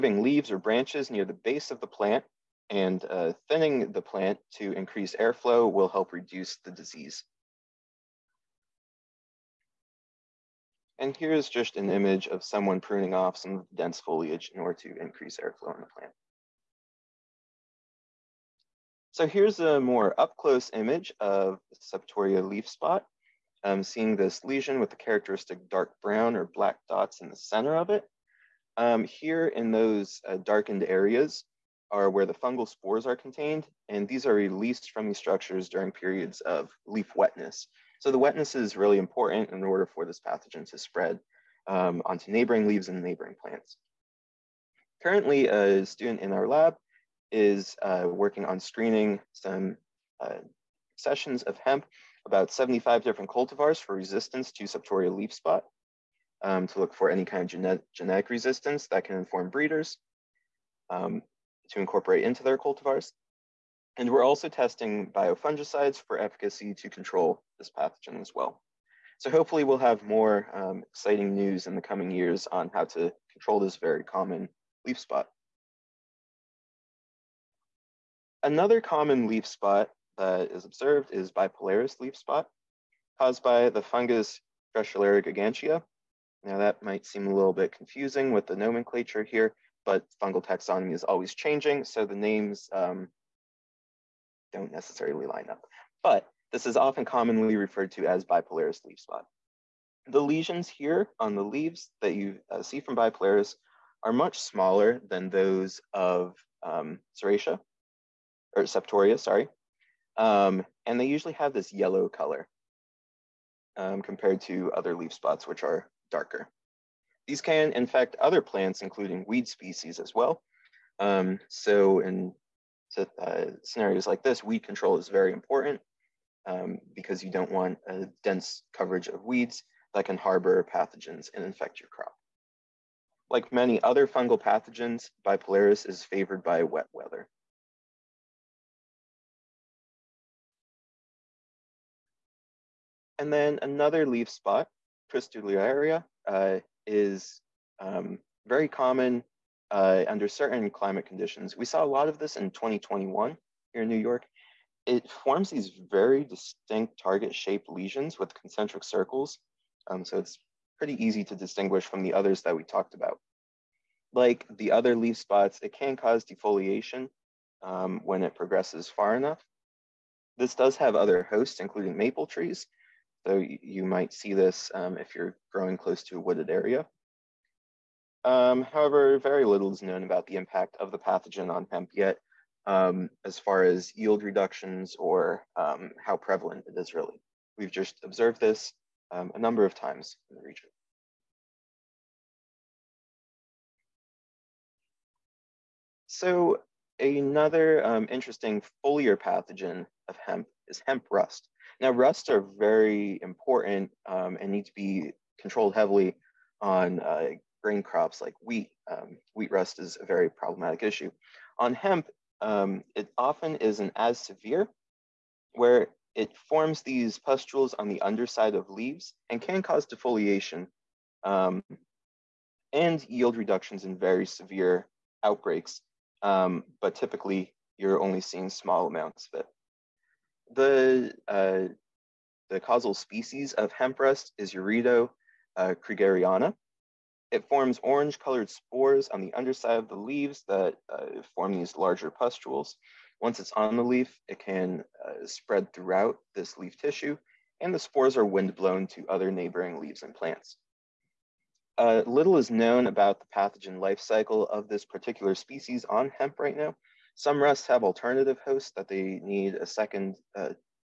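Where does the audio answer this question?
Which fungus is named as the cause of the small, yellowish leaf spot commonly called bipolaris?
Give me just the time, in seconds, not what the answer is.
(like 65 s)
84 s.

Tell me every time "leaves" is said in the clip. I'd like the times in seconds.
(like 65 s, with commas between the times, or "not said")
0 s, 42 s, 101 s, 218 s, 239 s, 249 s.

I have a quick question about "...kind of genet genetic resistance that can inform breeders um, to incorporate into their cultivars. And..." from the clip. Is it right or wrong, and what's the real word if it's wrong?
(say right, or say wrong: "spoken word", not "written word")
right.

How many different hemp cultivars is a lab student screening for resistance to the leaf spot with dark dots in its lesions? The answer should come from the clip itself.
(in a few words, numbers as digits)
75.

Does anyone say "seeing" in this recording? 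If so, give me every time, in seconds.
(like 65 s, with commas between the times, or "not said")
23 s, 228 s.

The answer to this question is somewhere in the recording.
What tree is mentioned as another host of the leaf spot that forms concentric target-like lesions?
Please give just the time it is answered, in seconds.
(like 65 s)
171 s.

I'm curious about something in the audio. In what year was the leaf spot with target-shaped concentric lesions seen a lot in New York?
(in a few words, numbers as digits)
2021.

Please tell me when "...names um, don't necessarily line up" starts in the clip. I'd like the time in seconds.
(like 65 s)
92 s.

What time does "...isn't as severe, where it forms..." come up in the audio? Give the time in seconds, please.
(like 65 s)
213 s.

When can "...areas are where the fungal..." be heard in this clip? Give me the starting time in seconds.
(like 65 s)
30 s.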